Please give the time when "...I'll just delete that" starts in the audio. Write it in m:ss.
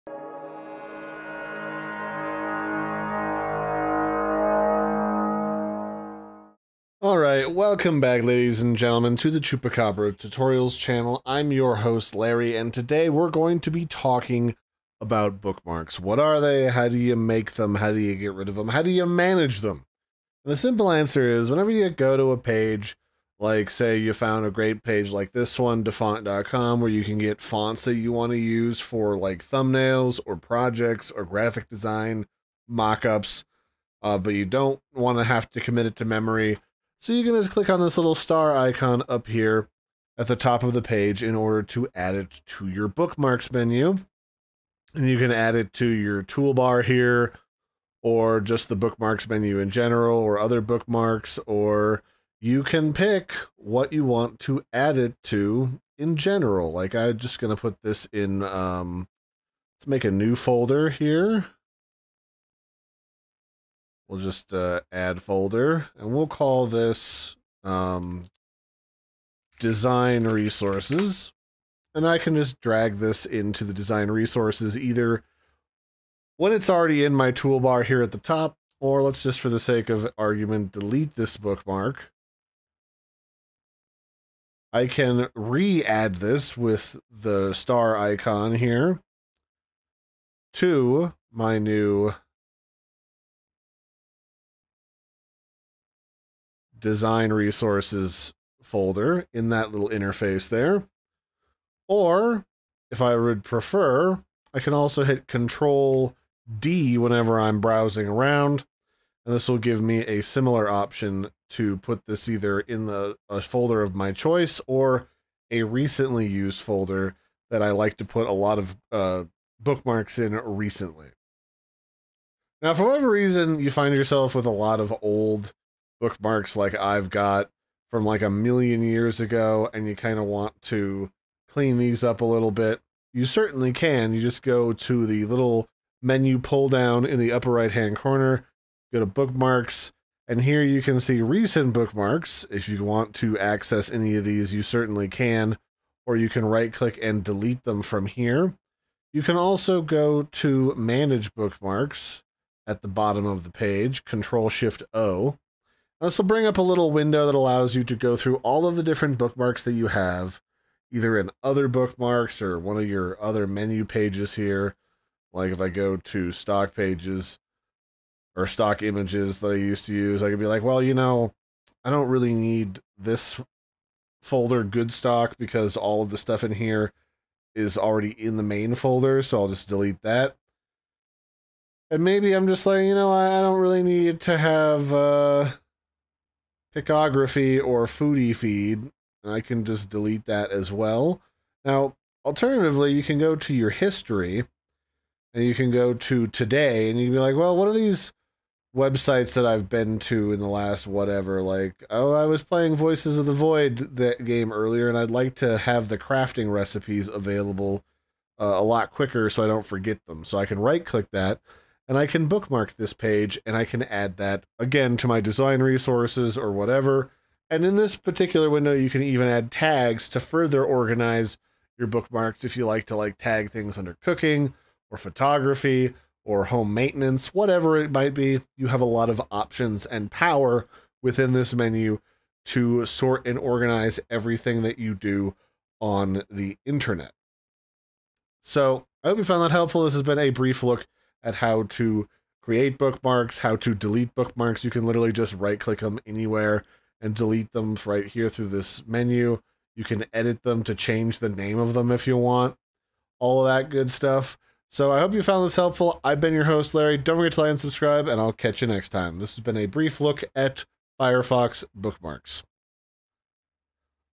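2:59.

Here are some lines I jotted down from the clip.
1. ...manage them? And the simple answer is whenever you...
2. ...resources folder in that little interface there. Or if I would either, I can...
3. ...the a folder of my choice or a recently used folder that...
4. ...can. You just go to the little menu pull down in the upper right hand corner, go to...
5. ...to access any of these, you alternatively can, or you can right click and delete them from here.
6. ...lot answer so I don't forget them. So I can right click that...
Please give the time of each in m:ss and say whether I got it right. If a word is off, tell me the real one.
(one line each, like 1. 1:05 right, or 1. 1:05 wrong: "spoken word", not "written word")
1. 0:19 right
2. 1:37 wrong: "prefer", not "either"
3. 1:52 right
4. 2:13 right
5. 2:23 wrong: "certainly", not "alternatively"
6. 3:28 wrong: "quicker", not "answer".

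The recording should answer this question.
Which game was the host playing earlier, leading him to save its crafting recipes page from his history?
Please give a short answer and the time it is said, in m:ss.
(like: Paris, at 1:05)
Voices of the Void, at 3:22.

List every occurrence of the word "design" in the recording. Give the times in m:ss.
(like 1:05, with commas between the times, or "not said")
0:31, 1:09, 1:13, 1:36, 3:35.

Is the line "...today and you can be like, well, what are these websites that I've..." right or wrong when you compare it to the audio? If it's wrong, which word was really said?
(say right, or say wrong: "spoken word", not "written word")
right.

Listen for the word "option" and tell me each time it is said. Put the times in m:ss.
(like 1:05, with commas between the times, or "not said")
1:50, 3:49.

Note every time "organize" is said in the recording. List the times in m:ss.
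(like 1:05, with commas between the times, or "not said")
3:40, 3:53.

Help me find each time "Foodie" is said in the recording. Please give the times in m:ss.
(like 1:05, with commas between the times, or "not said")
3:07.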